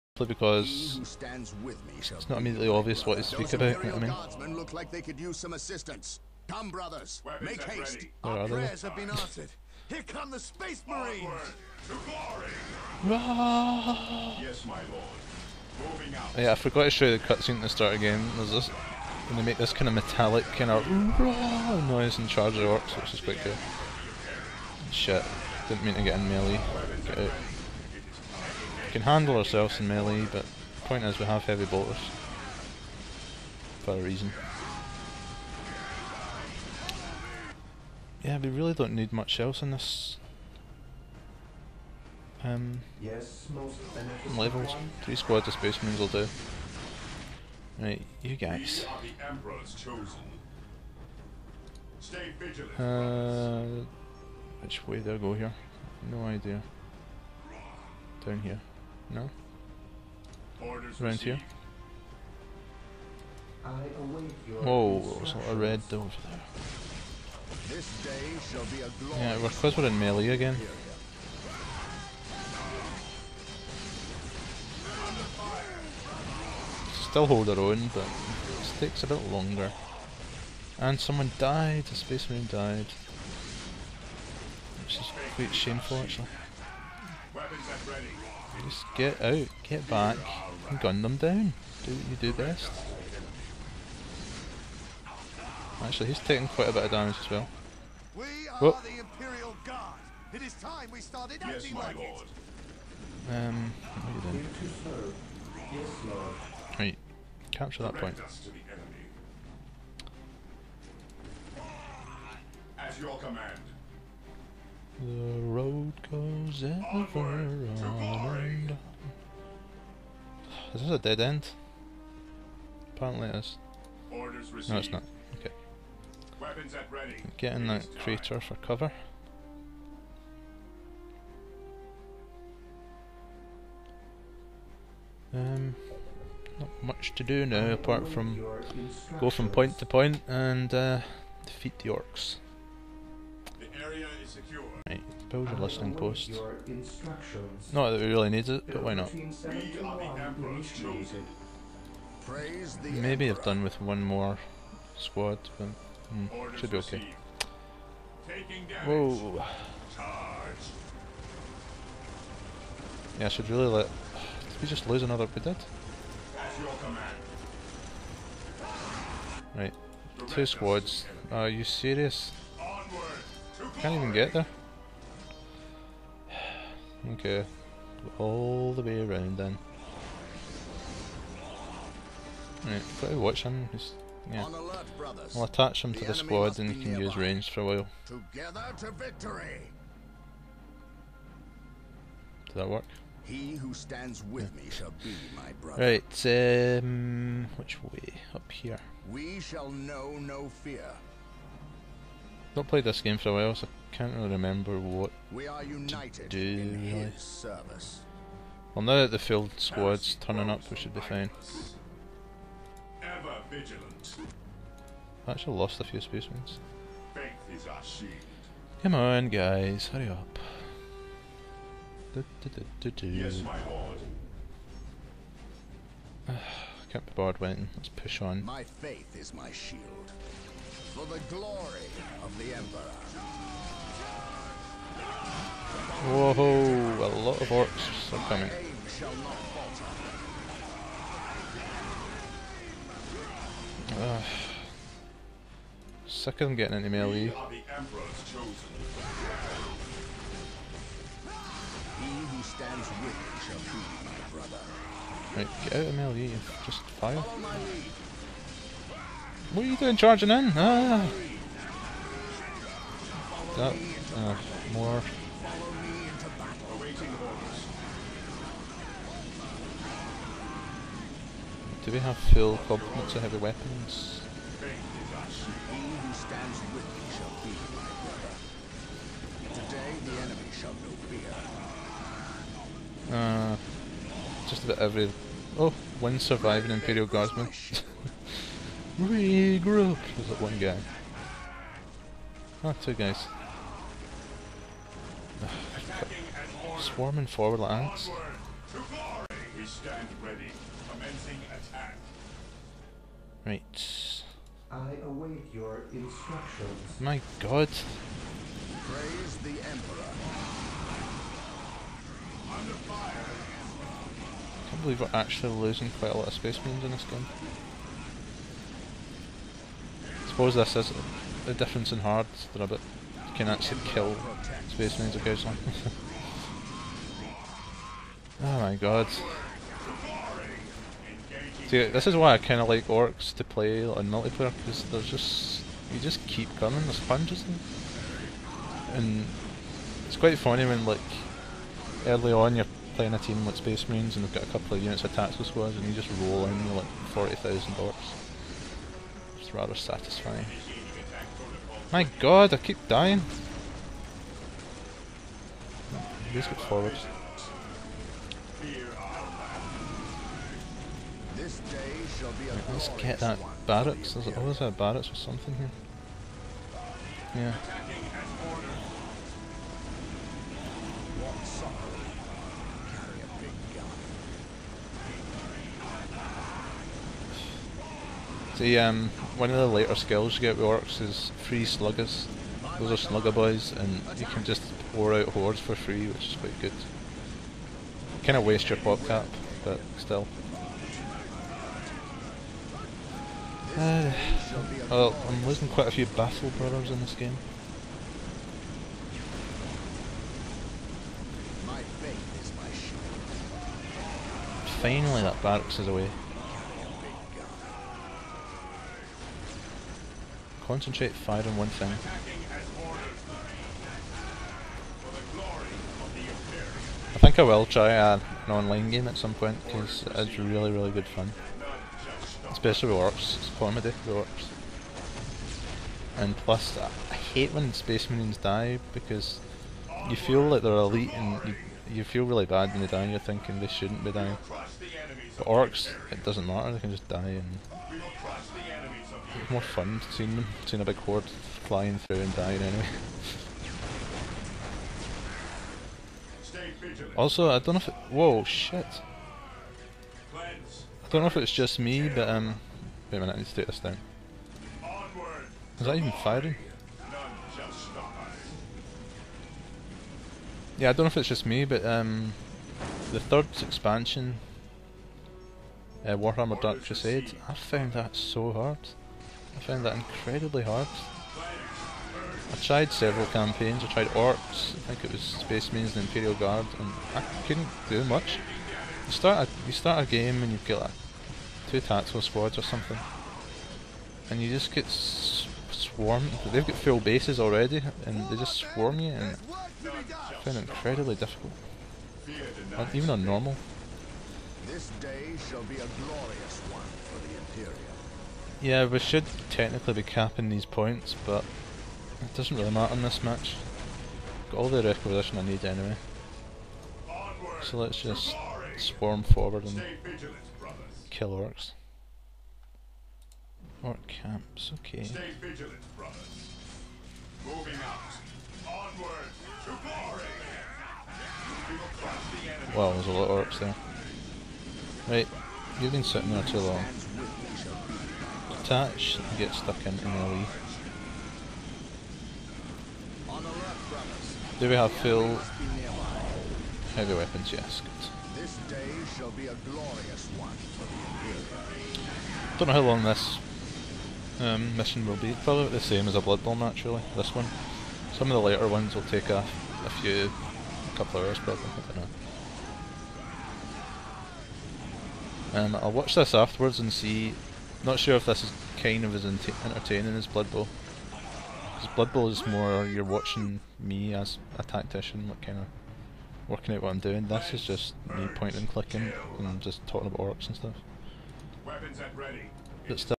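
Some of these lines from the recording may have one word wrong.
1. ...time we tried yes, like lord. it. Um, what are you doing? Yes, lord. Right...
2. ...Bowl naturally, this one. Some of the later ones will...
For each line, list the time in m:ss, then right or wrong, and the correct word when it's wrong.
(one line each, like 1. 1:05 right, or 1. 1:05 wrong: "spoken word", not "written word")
1. 1:40 wrong: "started", not "tried"
2. 9:06 right.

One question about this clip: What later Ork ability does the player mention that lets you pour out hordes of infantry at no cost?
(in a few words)
Free sluggers.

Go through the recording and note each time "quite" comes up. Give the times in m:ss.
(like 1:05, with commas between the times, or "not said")
0:23, 1:25, 1:36, 5:15, 5:40, 6:26, 6:35.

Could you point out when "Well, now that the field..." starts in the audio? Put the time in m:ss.
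3:28.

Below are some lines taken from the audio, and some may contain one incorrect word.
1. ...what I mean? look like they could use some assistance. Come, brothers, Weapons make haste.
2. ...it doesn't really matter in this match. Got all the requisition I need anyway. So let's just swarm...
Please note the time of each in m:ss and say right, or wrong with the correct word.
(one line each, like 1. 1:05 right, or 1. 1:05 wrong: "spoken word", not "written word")
1. 0:03 right
2. 8:22 right.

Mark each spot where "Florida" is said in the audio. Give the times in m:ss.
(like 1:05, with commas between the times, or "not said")
not said.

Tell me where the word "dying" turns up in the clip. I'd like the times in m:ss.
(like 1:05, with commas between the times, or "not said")
5:52, 7:14, 7:22.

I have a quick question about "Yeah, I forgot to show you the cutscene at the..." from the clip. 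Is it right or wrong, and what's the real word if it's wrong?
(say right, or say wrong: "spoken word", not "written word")
right.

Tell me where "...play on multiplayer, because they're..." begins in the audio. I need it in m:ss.
5:33.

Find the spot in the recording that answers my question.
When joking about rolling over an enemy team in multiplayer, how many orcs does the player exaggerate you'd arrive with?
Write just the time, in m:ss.
5:47.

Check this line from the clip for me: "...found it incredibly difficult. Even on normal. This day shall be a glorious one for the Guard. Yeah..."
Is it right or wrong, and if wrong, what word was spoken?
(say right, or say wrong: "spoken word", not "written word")
wrong: "Imperial", not "Guard".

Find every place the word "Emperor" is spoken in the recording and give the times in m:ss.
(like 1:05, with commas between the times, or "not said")
3:52, 5:09.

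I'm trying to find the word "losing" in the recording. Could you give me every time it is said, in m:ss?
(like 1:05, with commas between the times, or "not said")
5:15, 6:35.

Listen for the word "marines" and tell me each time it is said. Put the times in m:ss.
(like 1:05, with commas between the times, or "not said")
0:10, 0:45, 1:22, 5:16, 5:24, 5:43, 7:08, 7:55.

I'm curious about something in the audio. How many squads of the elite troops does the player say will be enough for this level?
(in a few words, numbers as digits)
3.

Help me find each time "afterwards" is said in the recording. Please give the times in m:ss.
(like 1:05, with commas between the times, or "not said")
9:16.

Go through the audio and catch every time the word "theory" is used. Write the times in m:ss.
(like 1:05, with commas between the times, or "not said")
not said.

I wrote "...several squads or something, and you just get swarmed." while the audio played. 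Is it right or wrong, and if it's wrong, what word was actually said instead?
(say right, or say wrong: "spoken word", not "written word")
wrong: "tactical", not "several".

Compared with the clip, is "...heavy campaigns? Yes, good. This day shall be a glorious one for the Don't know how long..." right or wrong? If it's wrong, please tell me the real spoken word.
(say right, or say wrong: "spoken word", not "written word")
wrong: "weapons", not "campaigns".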